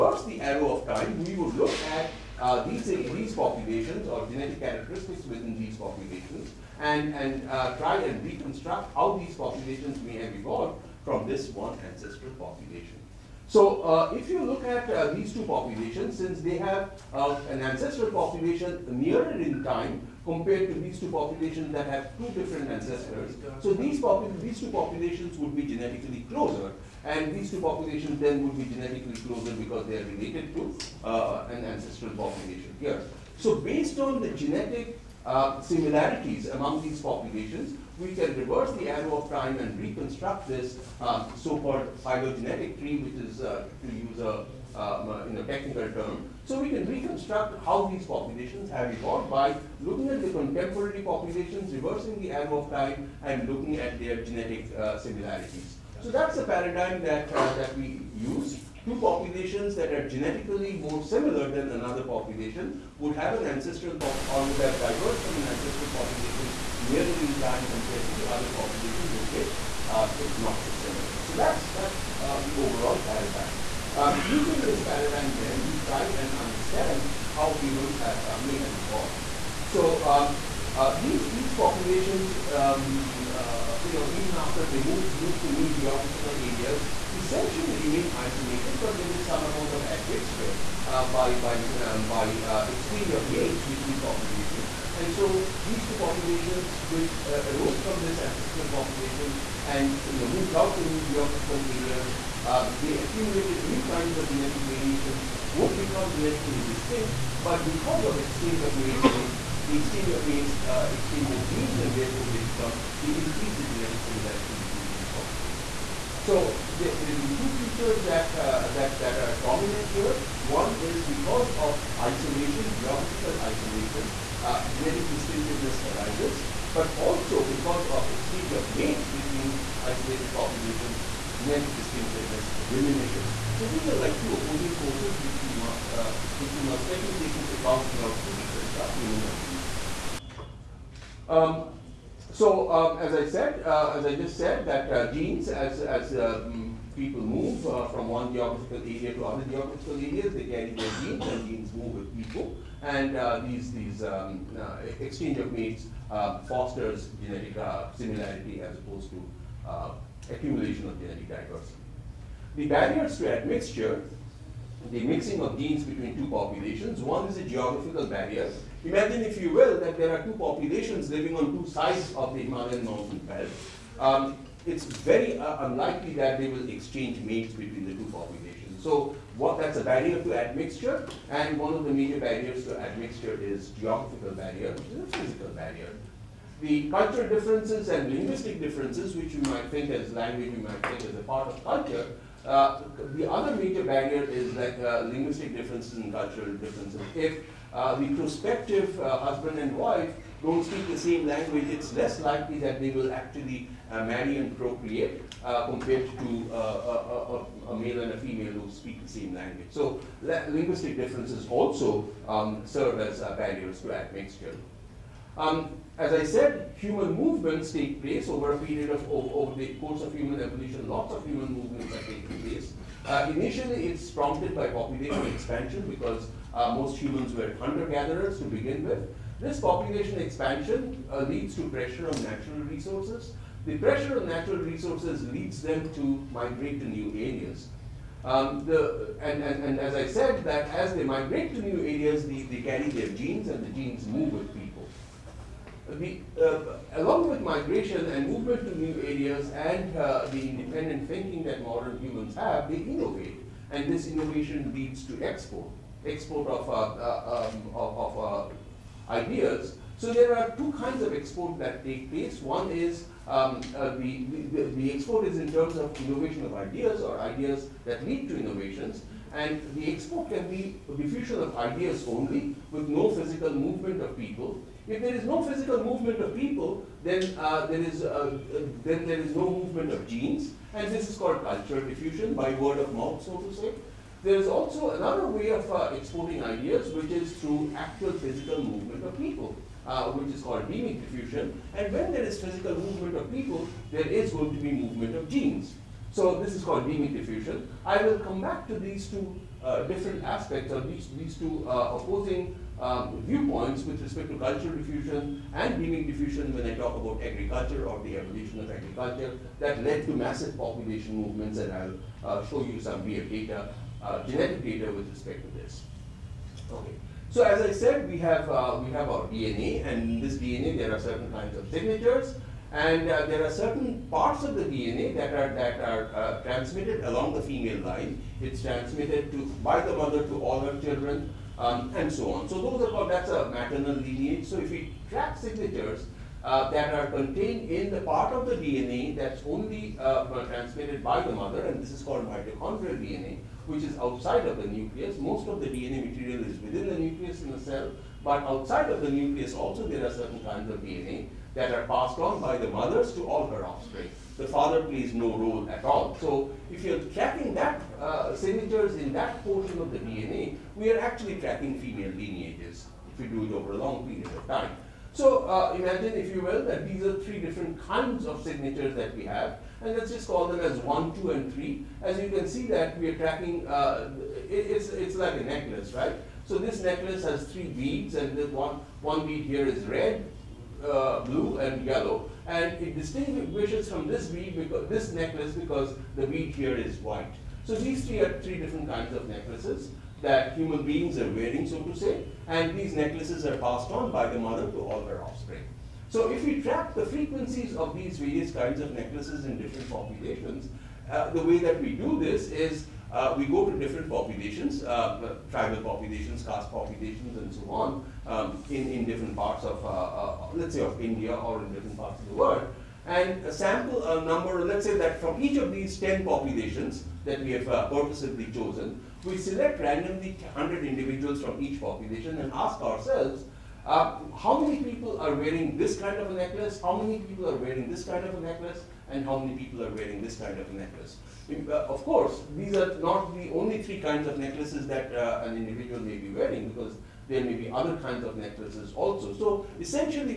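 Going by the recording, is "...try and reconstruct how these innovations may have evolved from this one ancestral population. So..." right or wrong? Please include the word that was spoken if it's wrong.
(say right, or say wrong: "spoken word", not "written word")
wrong: "populations", not "innovations".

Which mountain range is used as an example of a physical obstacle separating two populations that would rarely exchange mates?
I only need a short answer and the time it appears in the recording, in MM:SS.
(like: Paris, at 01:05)
Himalayan, at 02:52.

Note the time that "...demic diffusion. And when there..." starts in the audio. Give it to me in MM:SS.
04:50.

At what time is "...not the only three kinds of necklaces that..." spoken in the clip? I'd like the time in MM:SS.
07:12.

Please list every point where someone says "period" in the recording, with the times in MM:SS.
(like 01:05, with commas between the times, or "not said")
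03:38, 06:04.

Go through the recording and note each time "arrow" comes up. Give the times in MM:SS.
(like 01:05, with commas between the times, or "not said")
00:00, 00:38, 00:52.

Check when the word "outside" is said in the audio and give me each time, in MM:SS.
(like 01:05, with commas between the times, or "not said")
05:43, 05:48.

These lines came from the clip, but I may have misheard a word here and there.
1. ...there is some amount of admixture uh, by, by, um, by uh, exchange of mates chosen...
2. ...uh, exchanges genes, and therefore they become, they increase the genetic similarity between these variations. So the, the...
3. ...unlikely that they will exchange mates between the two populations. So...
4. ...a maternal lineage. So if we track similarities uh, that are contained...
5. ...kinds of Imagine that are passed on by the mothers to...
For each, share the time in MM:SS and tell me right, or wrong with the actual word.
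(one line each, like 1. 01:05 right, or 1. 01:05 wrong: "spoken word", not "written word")
1. 01:28 wrong: "between", not "chosen"
2. 01:50 wrong: "populations", not "variations"
3. 02:55 right
4. 05:33 wrong: "signatures", not "similarities"
5. 05:50 wrong: "DNA", not "Imagine".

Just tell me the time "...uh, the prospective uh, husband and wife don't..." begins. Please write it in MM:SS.
03:17.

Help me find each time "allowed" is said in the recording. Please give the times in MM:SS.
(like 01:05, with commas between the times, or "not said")
not said.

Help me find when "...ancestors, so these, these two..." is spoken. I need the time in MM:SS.
00:22.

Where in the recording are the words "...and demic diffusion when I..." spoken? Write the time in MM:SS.
05:05.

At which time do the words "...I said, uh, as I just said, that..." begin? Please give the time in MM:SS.
02:23.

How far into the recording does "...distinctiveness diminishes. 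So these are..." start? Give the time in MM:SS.
02:11.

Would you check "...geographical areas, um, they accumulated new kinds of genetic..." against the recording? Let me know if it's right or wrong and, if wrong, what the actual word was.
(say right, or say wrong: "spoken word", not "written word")
right.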